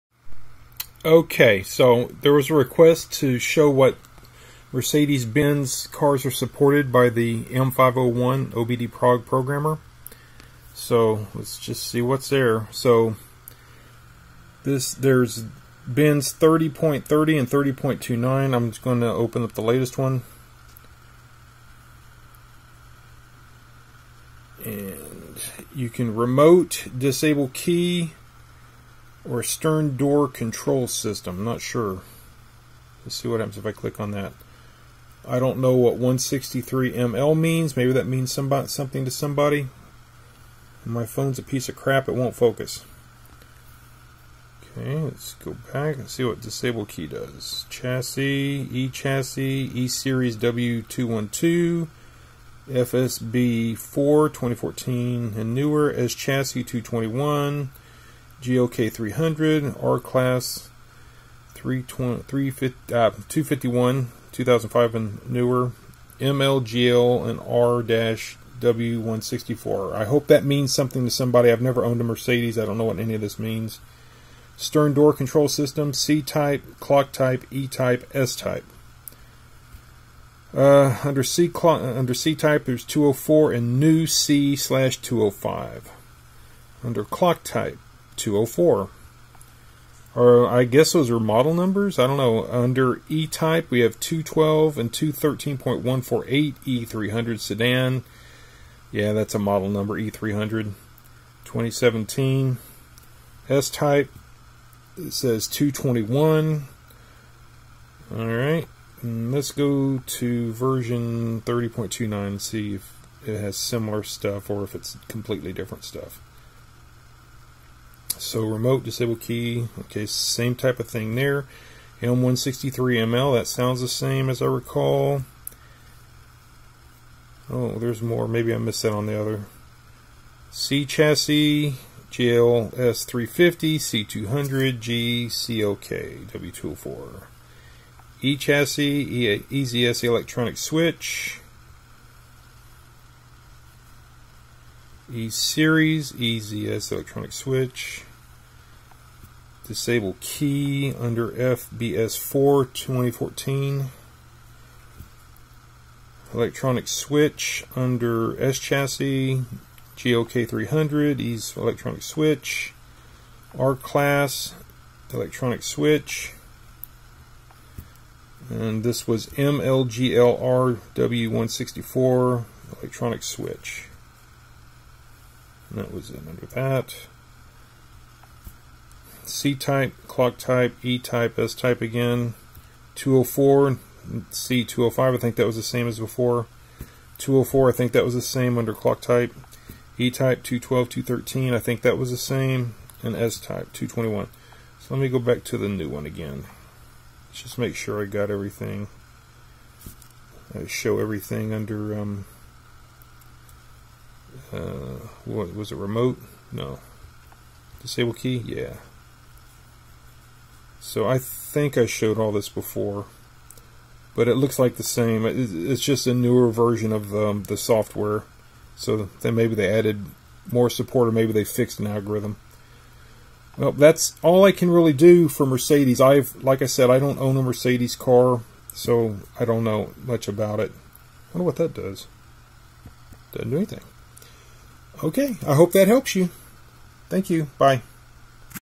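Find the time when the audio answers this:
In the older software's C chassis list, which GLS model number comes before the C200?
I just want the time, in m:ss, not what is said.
2:12.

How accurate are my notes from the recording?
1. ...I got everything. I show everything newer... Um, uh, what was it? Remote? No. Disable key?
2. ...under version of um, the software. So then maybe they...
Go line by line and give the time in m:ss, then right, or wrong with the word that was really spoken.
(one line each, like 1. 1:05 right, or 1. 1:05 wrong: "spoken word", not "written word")
1. 3:18 wrong: "under", not "newer"
2. 3:36 wrong: "newer", not "under".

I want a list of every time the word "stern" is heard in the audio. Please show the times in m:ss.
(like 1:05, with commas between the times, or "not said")
0:29, 1:14.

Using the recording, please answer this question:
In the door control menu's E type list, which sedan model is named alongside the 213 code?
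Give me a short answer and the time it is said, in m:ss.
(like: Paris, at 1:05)
E300, at 1:36.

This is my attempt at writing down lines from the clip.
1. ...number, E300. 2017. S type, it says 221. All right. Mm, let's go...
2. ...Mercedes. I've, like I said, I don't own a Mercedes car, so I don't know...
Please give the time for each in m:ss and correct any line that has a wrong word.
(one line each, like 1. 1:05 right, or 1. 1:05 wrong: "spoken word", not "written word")
1. 1:39 right
2. 3:45 right.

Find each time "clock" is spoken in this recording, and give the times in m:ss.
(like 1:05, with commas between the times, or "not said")
1:16, 1:21, 1:27, 3:00, 3:08.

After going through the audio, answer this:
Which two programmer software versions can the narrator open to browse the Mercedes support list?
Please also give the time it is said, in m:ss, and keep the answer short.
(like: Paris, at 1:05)
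30.30 and 30.29, at 0:16.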